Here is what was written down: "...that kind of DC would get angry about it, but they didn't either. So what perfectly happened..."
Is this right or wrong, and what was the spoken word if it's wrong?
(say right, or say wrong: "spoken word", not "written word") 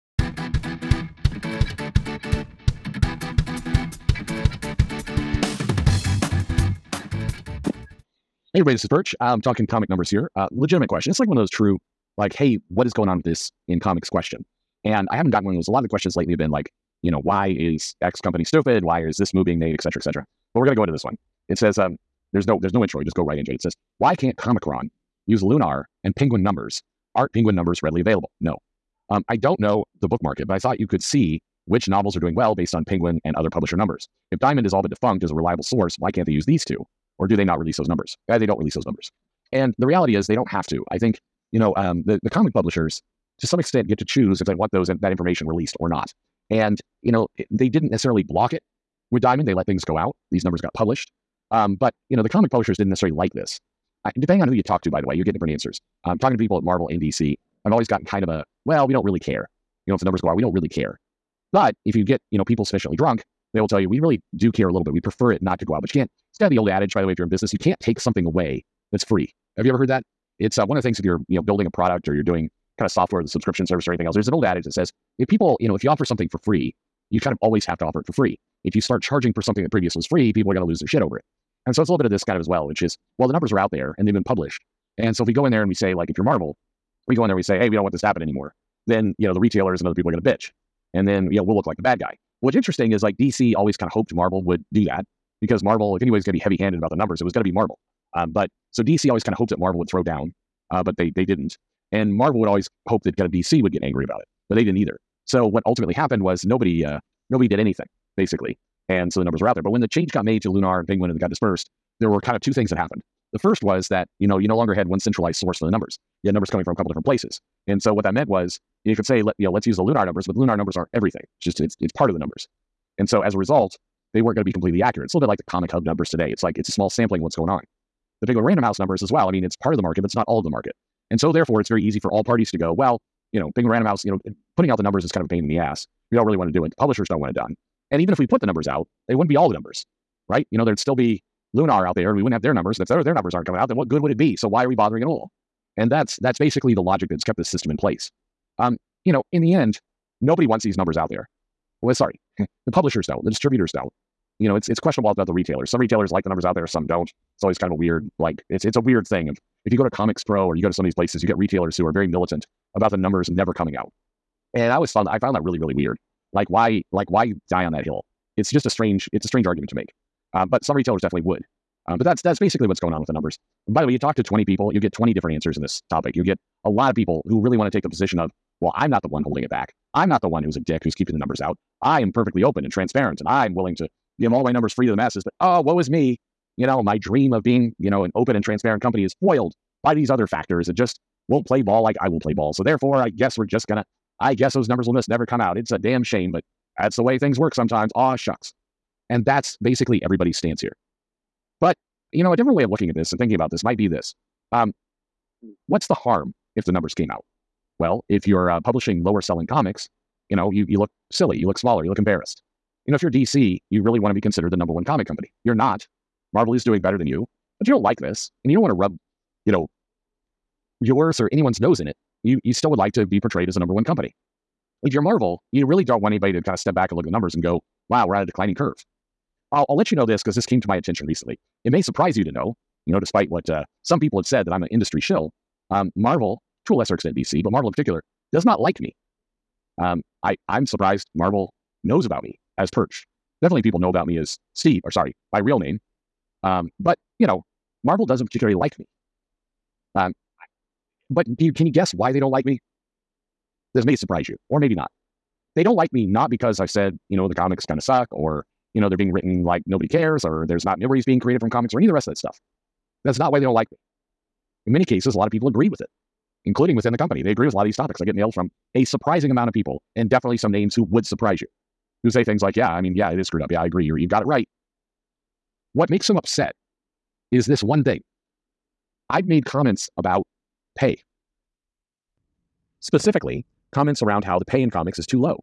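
wrong: "ultimately", not "perfectly".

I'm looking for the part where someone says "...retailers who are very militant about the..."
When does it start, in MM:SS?
02:41.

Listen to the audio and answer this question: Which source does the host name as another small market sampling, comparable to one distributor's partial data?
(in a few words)
ComicHub.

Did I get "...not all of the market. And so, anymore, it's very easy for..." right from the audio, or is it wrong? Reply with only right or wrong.
wrong.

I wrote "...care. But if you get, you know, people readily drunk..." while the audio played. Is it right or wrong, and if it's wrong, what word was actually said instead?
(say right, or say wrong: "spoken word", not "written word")
wrong: "sufficiently", not "readily".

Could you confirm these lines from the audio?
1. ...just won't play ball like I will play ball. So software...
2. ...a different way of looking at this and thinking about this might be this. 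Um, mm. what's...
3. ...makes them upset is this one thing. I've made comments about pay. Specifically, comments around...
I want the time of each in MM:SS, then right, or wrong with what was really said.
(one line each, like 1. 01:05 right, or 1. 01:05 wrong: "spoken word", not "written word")
1. 03:10 wrong: "therefore", not "software"
2. 03:22 right
3. 04:35 right.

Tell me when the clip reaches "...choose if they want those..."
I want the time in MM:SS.
00:44.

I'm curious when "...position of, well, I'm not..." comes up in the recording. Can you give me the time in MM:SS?
02:57.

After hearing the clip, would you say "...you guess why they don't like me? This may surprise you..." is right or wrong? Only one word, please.
right.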